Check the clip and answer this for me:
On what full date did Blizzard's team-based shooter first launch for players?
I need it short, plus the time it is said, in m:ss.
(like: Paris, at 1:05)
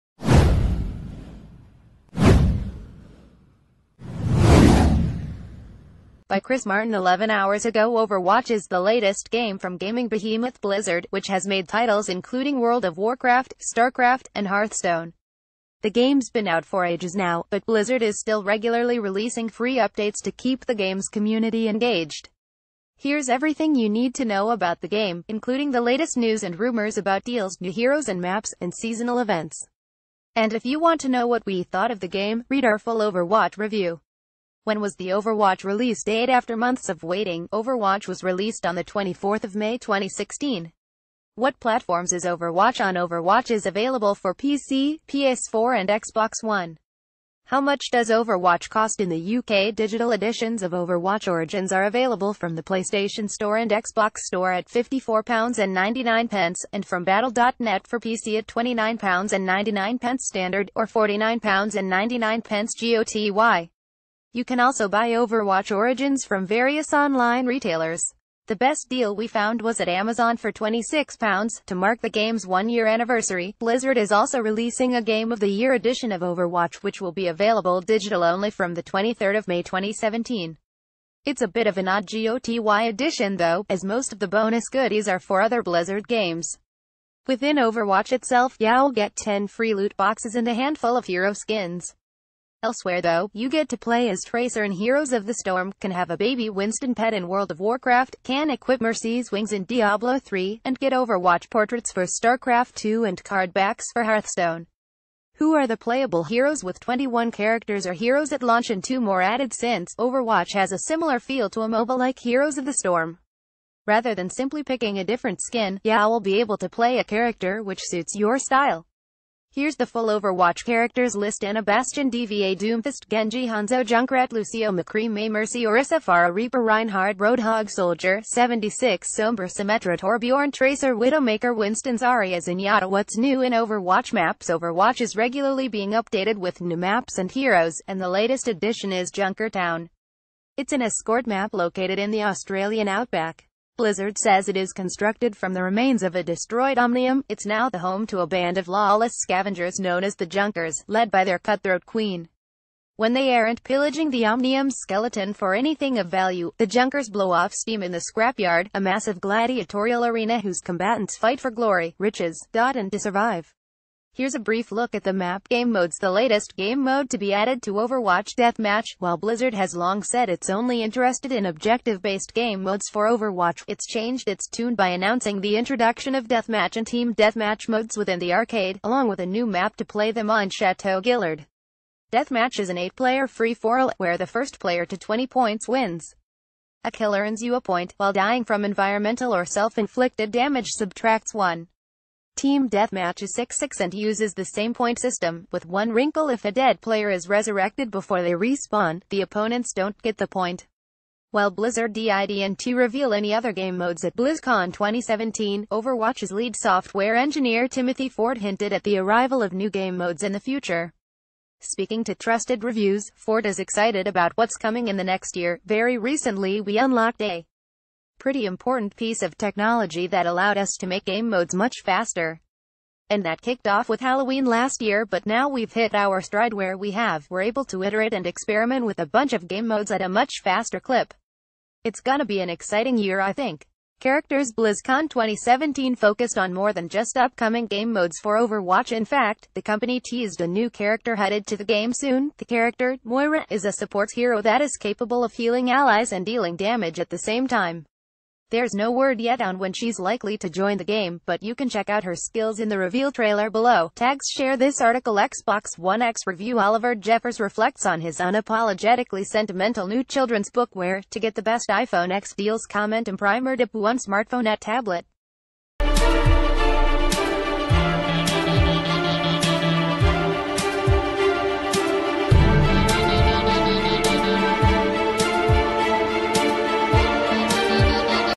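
24th of May 2016, at 0:38.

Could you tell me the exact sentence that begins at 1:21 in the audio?
It's a bit of an odd GOTY edition though, as most of the bonus goodies are for other Blizzard games.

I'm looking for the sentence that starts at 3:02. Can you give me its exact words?
Deathmatch is an eight-player free-for-all, where the first player to 20 points wins.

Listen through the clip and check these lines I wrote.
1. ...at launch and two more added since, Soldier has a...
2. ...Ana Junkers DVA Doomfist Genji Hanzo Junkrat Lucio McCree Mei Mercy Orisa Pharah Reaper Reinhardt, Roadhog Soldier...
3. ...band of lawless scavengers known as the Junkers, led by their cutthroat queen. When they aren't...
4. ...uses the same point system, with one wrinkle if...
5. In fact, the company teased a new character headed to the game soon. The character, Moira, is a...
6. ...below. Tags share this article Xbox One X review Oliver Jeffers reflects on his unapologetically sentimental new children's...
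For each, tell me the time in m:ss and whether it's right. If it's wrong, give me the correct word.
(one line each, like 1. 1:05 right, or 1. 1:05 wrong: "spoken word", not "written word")
1. 1:48 wrong: "Overwatch", not "Soldier"
2. 2:01 wrong: "Bastion", not "Junkers"
3. 2:28 right
4. 3:13 right
5. 3:58 right
6. 4:13 right.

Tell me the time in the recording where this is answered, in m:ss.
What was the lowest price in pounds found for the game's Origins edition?
1:10.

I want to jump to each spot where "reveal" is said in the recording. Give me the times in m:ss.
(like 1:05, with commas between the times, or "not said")
3:22, 4:12.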